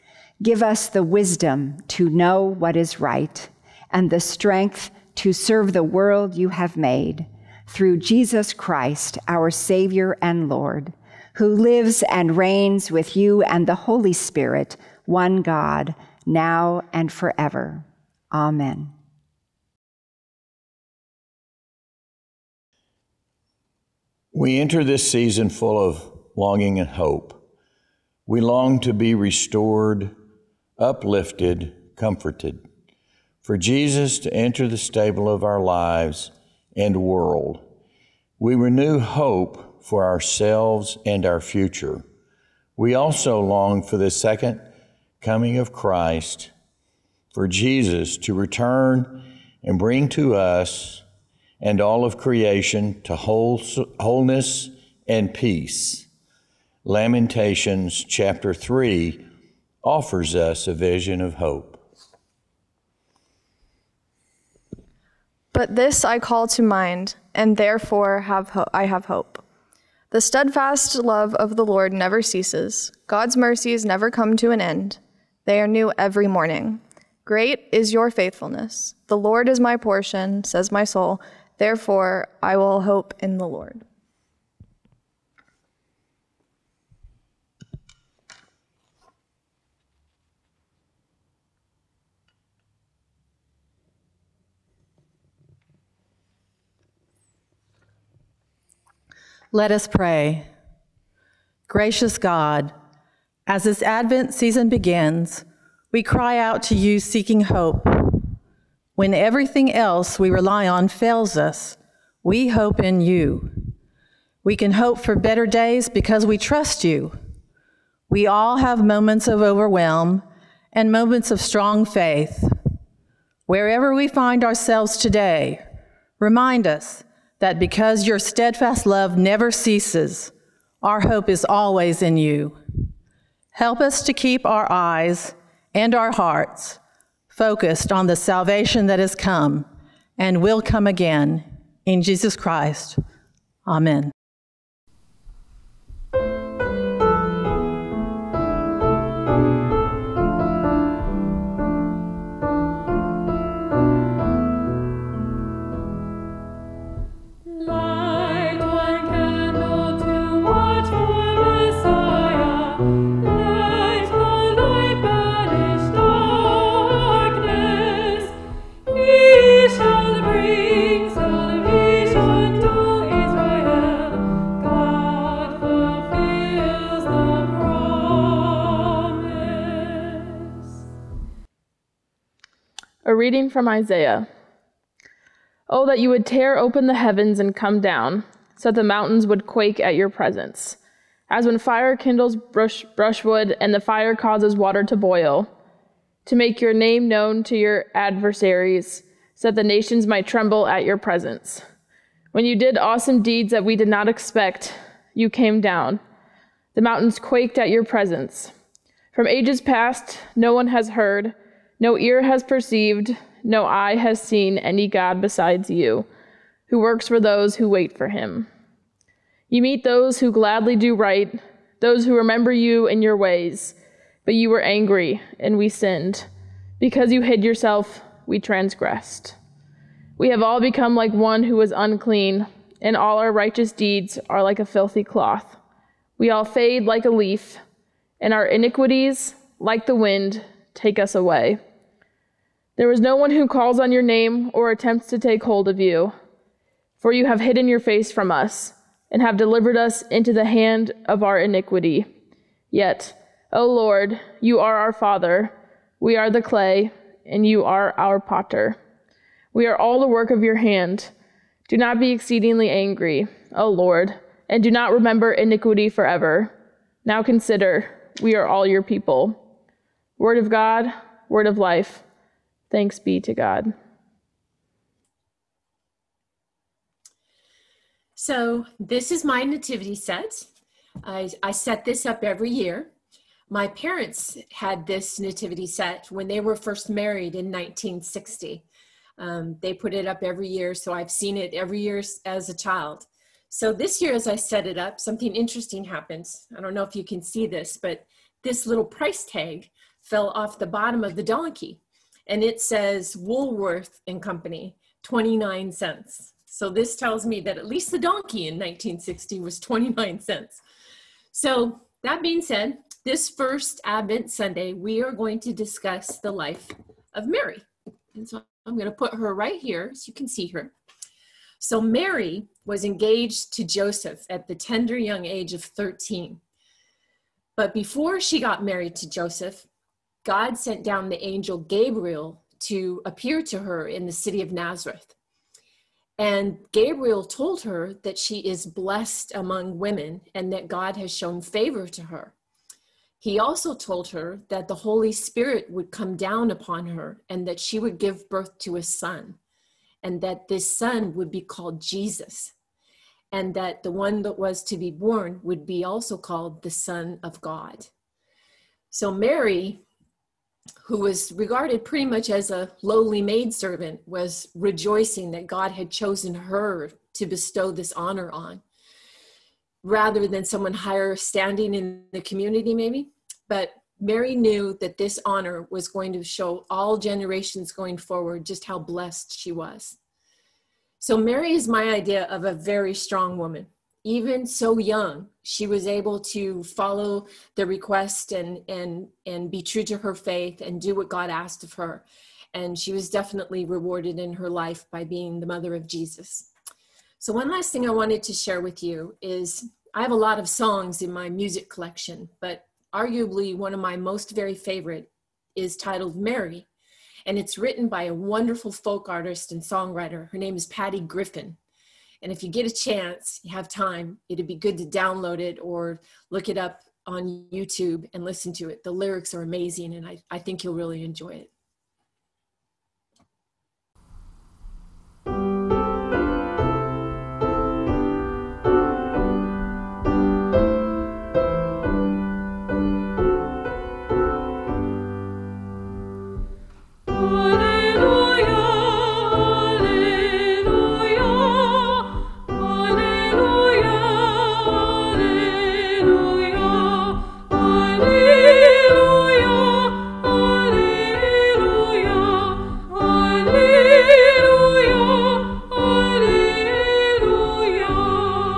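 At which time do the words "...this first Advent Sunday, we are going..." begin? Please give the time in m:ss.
5:13.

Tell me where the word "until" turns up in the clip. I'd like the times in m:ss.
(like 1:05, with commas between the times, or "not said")
not said.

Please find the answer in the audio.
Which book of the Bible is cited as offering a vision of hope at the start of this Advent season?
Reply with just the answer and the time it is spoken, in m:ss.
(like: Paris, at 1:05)
Lamentations, at 0:56.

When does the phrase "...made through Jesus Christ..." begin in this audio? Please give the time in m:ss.
0:06.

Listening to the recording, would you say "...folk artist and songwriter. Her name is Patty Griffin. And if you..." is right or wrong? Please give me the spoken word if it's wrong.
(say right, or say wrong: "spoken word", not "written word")
right.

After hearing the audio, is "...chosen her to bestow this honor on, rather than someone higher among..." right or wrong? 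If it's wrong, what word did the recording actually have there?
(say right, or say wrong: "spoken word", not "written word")
wrong: "standing", not "among".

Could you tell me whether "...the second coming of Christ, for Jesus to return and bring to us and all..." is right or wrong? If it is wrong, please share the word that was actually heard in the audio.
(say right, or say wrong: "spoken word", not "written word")
right.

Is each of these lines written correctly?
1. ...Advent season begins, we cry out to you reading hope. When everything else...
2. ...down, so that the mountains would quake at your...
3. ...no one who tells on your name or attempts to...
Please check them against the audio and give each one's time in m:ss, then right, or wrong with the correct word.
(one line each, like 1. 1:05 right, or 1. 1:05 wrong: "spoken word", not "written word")
1. 1:43 wrong: "seeking", not "reading"
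2. 3:07 right
3. 4:03 wrong: "calls", not "tells".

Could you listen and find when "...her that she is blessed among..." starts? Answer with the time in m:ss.
5:37.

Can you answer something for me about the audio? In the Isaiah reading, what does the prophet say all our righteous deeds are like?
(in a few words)
a filthy cloth.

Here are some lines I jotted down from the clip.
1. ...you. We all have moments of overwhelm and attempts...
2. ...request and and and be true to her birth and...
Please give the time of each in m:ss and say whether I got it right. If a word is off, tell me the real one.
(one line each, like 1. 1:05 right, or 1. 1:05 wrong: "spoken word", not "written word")
1. 1:56 wrong: "moments", not "attempts"
2. 6:27 wrong: "faith", not "birth".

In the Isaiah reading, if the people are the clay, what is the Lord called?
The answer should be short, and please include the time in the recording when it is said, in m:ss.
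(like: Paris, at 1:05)
our potter, at 4:17.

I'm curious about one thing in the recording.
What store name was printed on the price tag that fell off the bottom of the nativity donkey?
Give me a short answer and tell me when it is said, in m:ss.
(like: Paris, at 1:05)
Woolworth and Company, at 5:03.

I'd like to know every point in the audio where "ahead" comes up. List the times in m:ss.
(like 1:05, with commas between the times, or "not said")
not said.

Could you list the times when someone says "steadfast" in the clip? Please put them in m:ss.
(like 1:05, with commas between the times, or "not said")
1:10, 2:08.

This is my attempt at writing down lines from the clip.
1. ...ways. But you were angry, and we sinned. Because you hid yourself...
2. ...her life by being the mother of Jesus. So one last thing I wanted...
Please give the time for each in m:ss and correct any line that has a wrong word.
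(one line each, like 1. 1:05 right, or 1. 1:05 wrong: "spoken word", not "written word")
1. 3:43 right
2. 6:34 right.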